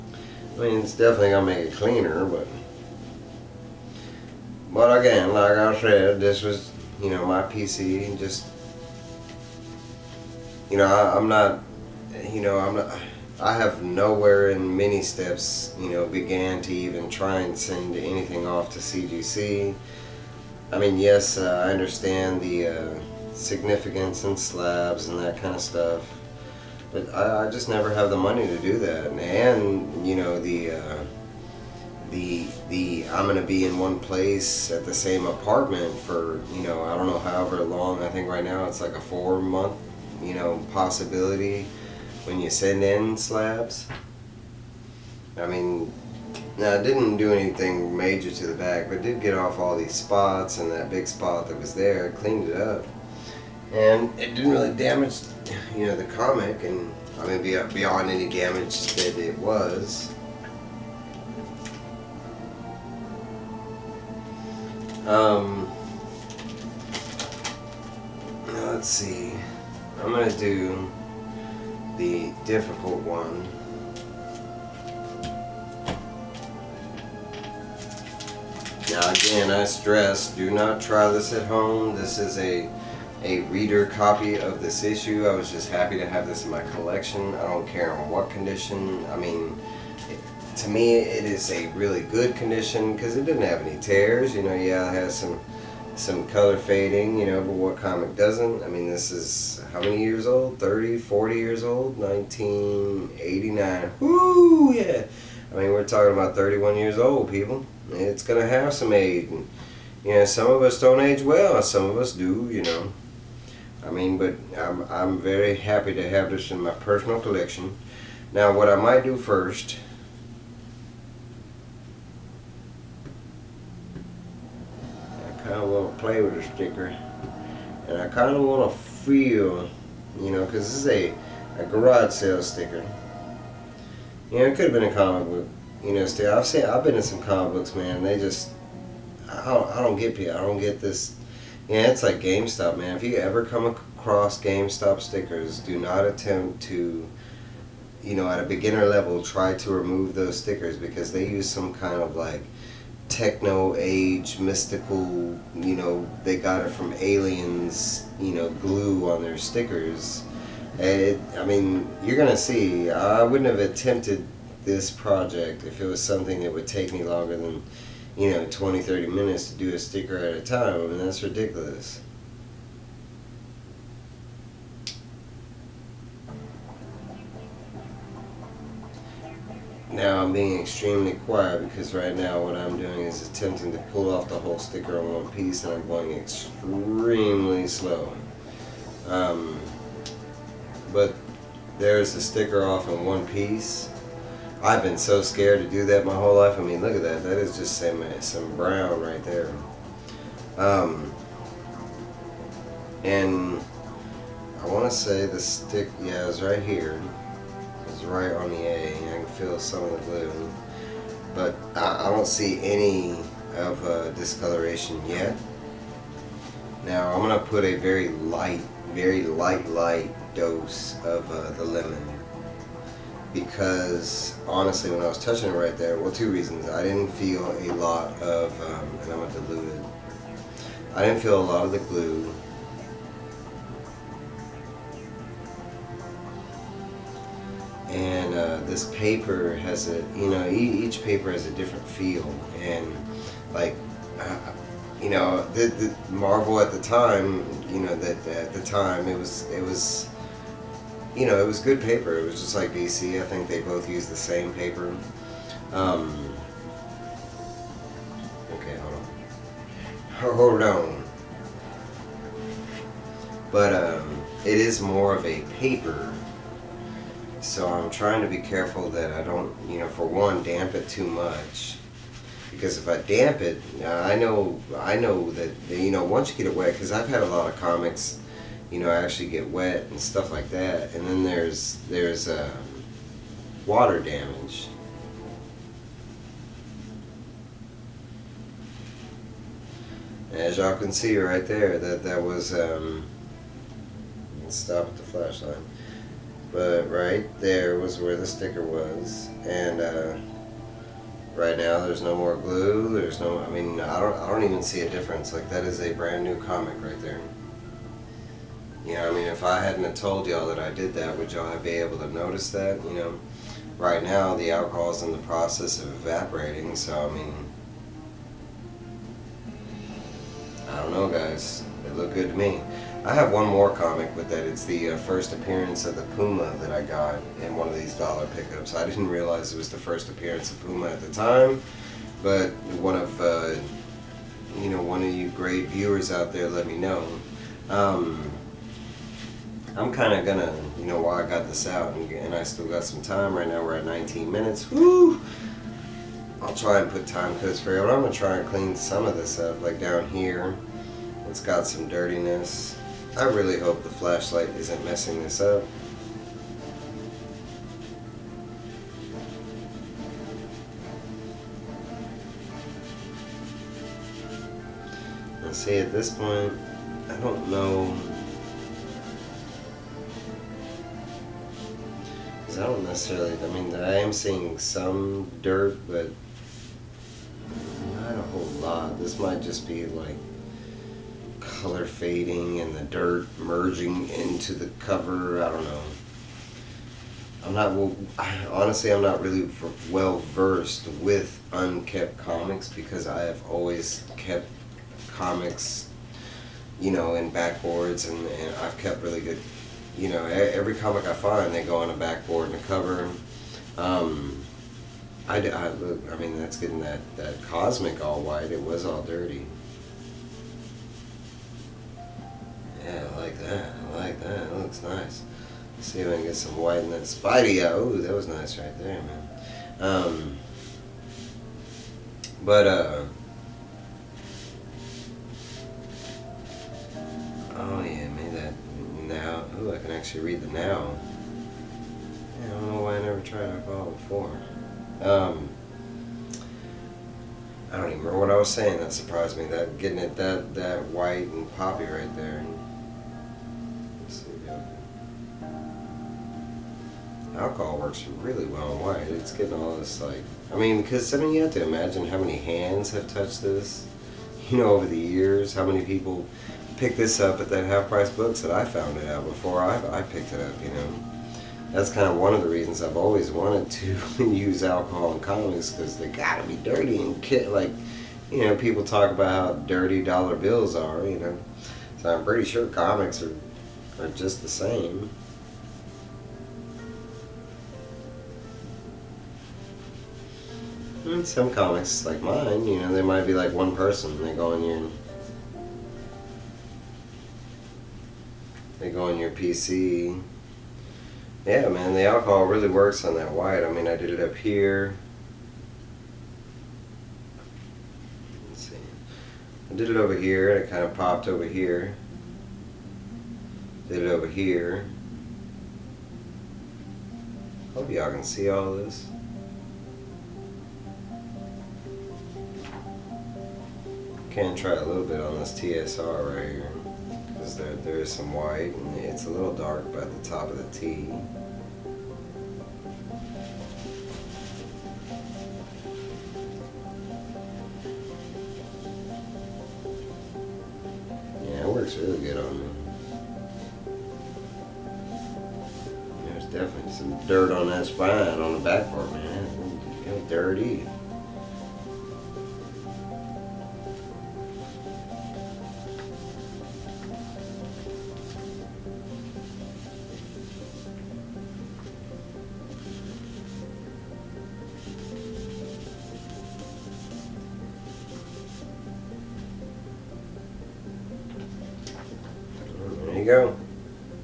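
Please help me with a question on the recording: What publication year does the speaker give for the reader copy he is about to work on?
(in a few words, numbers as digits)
1989.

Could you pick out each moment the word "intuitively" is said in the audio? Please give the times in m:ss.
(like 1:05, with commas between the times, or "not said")
not said.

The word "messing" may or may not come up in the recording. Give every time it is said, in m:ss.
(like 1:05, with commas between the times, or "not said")
5:54.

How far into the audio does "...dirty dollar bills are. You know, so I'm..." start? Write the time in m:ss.
7:49.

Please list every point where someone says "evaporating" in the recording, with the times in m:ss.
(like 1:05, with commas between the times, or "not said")
5:15.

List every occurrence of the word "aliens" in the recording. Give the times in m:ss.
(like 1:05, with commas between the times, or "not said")
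2:36.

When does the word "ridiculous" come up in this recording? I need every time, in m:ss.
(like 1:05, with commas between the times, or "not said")
2:51.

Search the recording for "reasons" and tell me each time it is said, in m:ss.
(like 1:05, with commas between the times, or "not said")
3:46, 7:42.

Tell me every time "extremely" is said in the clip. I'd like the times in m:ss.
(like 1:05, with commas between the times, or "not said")
3:00, 3:06.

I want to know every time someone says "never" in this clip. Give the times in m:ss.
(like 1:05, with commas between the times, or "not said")
0:27, 7:13.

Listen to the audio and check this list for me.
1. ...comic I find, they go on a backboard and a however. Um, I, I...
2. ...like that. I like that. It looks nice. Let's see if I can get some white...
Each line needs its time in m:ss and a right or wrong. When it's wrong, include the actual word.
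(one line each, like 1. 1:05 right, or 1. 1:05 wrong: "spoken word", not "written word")
1. 6:40 wrong: "cover", not "however"
2. 6:53 right.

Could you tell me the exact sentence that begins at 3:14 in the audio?
I've been so scared to do that my whole life.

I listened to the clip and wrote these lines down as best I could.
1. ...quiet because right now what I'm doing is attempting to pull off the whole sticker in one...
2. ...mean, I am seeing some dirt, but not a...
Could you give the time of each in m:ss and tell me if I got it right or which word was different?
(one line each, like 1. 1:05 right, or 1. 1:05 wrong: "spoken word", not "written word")
1. 3:01 right
2. 6:13 right.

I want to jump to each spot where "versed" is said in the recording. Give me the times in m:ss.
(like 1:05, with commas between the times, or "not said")
6:30.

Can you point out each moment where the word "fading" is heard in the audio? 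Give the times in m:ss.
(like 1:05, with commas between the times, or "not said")
1:36, 6:21.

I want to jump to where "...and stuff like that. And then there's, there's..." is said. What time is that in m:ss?
4:39.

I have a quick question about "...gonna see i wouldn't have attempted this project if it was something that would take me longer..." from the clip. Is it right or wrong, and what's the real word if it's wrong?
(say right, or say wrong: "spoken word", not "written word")
right.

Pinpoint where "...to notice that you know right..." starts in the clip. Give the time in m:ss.
5:11.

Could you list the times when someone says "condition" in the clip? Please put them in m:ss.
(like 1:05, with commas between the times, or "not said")
1:28, 1:32.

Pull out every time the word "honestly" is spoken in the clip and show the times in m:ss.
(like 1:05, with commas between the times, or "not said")
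3:44, 6:28.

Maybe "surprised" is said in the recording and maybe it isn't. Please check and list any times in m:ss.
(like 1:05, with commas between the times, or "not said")
7:18.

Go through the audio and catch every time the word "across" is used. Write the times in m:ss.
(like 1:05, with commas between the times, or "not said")
2:23.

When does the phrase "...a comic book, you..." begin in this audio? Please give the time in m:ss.
2:14.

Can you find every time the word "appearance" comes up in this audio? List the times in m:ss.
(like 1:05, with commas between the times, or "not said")
5:25, 5:30.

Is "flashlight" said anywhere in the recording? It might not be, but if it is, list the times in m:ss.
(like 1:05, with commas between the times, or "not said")
4:55, 5:53.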